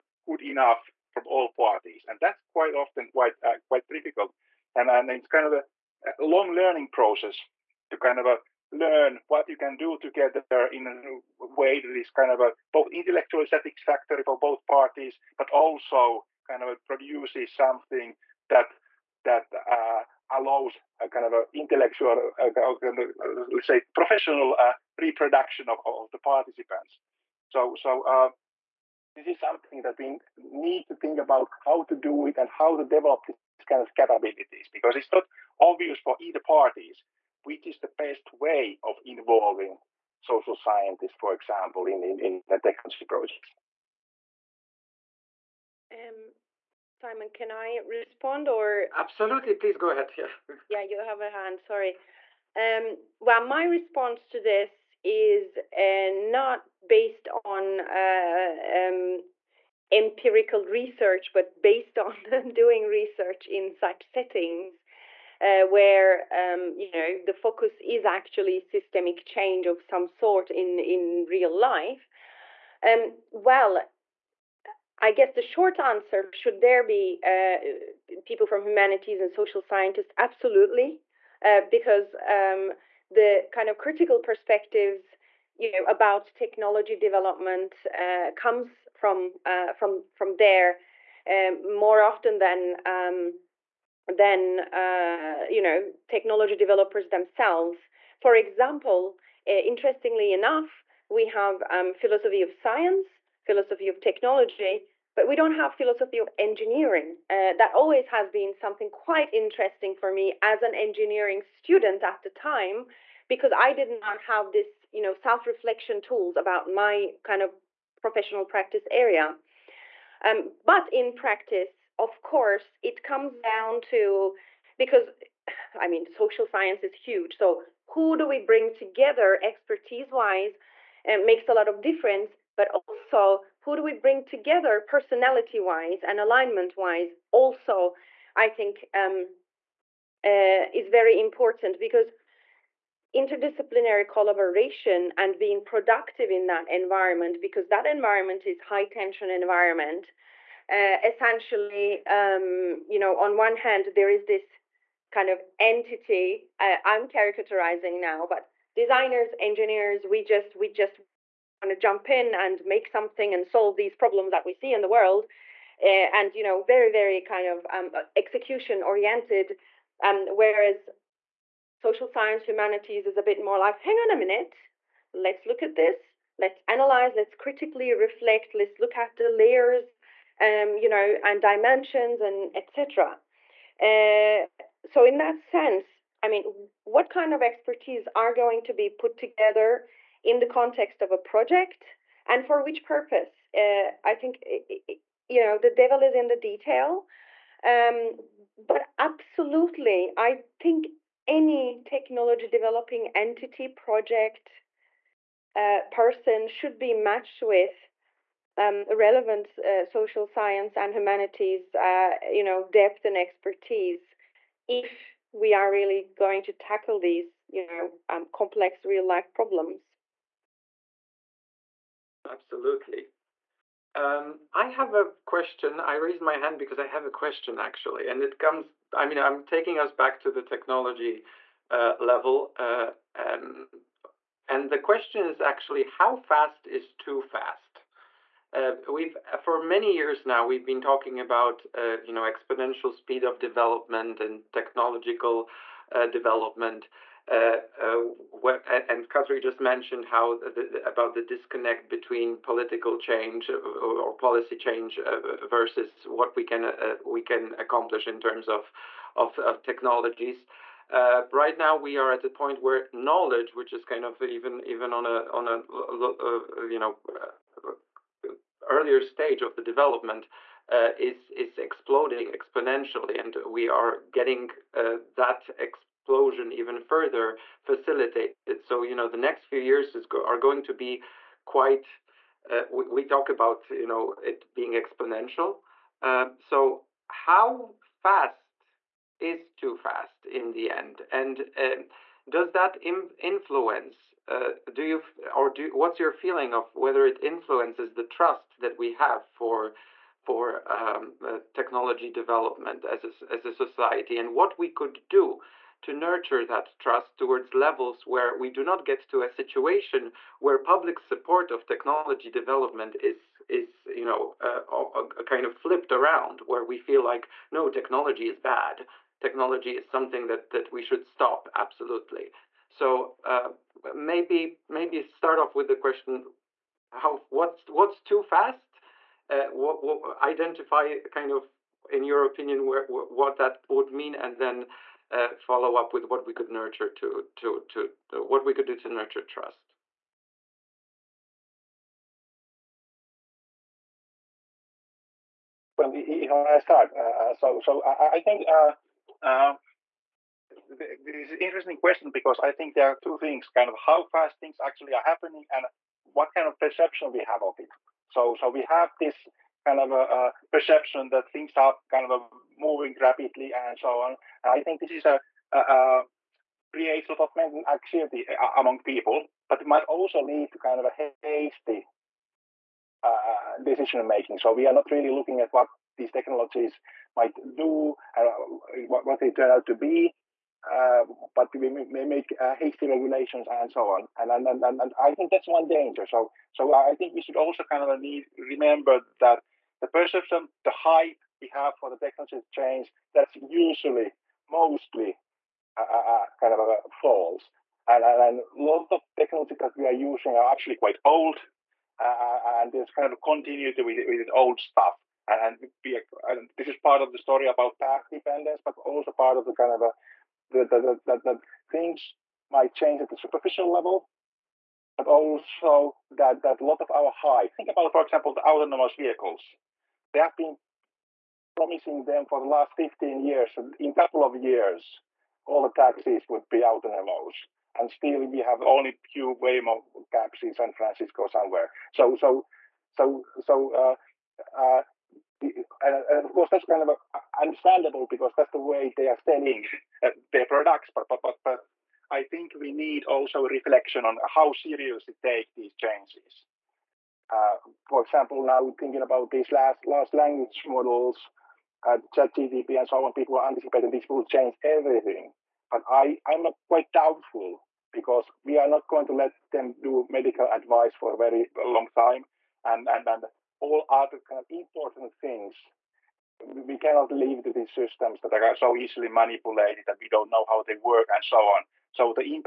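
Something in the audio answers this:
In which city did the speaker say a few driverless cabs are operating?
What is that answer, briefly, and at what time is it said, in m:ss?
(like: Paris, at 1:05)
San Francisco, at 7:10.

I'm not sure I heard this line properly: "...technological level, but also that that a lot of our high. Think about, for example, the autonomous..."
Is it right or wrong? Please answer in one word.
wrong.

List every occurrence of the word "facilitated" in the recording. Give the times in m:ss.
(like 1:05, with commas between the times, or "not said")
4:37.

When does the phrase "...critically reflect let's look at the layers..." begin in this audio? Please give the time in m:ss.
2:57.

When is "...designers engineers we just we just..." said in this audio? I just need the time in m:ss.
2:38.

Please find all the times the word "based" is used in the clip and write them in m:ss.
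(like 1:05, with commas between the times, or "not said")
0:56, 1:01.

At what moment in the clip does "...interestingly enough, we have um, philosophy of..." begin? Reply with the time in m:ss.
1:39.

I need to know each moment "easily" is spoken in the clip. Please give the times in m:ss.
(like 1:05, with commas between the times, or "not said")
7:48.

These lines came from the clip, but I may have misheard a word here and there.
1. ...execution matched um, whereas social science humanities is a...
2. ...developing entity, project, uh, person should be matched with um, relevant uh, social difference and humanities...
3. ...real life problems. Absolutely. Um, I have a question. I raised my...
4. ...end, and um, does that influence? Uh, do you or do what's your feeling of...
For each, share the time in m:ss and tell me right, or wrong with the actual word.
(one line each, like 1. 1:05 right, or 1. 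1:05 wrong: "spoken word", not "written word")
1. 2:48 wrong: "oriented", not "matched"
2. 3:22 wrong: "science", not "difference"
3. 3:38 right
4. 4:50 right.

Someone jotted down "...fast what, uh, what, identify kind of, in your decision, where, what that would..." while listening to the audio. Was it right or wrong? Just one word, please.
wrong.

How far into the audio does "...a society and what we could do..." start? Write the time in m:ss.
5:03.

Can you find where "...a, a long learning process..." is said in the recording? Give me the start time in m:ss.
0:05.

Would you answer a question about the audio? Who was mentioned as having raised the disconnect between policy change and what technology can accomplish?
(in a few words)
Katri.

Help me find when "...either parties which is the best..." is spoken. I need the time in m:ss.
0:36.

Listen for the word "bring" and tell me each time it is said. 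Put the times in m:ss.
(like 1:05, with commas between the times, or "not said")
2:08, 2:13.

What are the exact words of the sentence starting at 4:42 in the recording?
Uh, we, we, talk about you know it being exponential.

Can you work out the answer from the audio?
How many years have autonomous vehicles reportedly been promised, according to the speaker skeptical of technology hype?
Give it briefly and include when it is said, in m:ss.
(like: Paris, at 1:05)
15, at 7:02.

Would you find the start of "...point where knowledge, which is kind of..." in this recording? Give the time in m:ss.
4:22.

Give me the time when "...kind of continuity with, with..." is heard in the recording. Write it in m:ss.
6:42.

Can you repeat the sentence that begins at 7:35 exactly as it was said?
But I, I'm not quite doubtful because we are not going to let them do medical advice for a very long time.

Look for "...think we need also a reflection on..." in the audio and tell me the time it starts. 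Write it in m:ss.
7:22.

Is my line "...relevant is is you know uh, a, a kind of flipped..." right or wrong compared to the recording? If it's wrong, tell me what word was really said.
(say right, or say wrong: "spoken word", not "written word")
wrong: "development", not "relevant".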